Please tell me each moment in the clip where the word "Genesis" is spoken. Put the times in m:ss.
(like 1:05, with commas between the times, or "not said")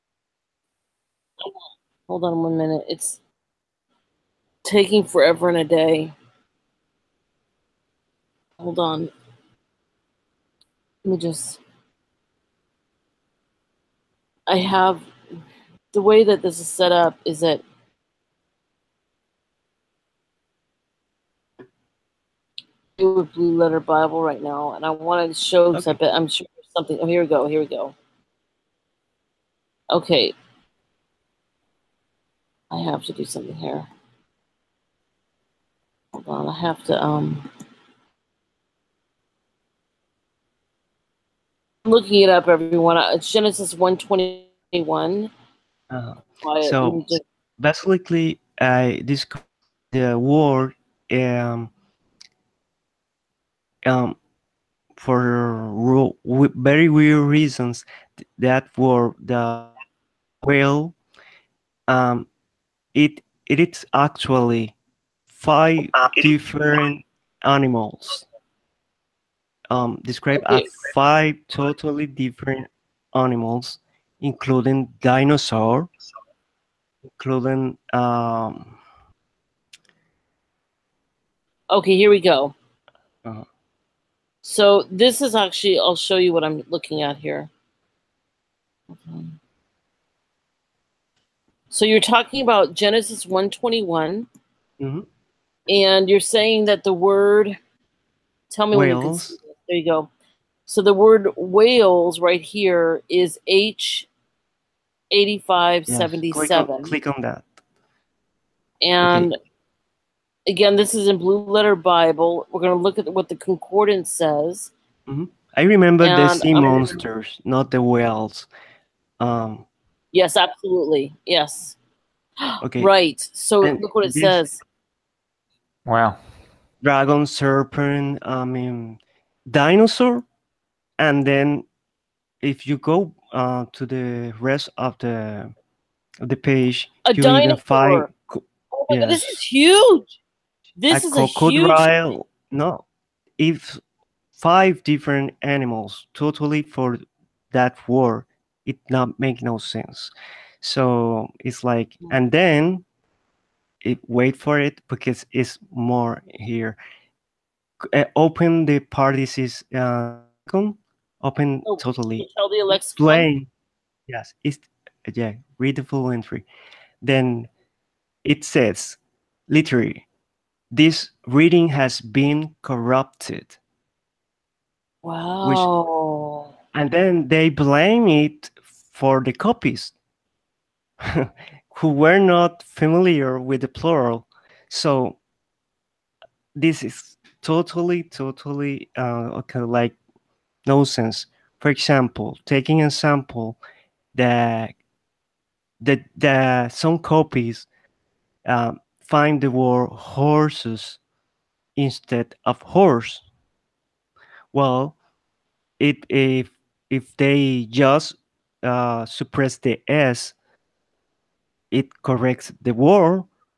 0:43, 1:32.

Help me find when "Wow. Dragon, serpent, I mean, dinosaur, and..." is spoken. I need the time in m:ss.
2:05.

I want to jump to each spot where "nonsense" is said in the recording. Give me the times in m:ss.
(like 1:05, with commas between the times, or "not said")
3:10.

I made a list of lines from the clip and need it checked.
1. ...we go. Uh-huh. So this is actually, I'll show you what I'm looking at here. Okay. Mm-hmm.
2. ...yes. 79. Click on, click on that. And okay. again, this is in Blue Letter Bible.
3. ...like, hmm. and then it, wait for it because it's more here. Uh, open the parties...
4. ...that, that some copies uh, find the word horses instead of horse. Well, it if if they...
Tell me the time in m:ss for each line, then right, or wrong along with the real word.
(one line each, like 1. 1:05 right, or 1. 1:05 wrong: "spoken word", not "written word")
1. 1:22 right
2. 1:45 wrong: "77", not "79"
3. 2:31 right
4. 3:15 right.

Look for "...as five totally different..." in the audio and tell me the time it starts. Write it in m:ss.
1:10.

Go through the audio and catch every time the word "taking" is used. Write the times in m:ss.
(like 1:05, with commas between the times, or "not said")
0:04, 3:12.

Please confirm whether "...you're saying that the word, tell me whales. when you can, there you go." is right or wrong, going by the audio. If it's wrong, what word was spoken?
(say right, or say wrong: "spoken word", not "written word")
right.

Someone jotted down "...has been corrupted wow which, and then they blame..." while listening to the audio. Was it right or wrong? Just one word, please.
right.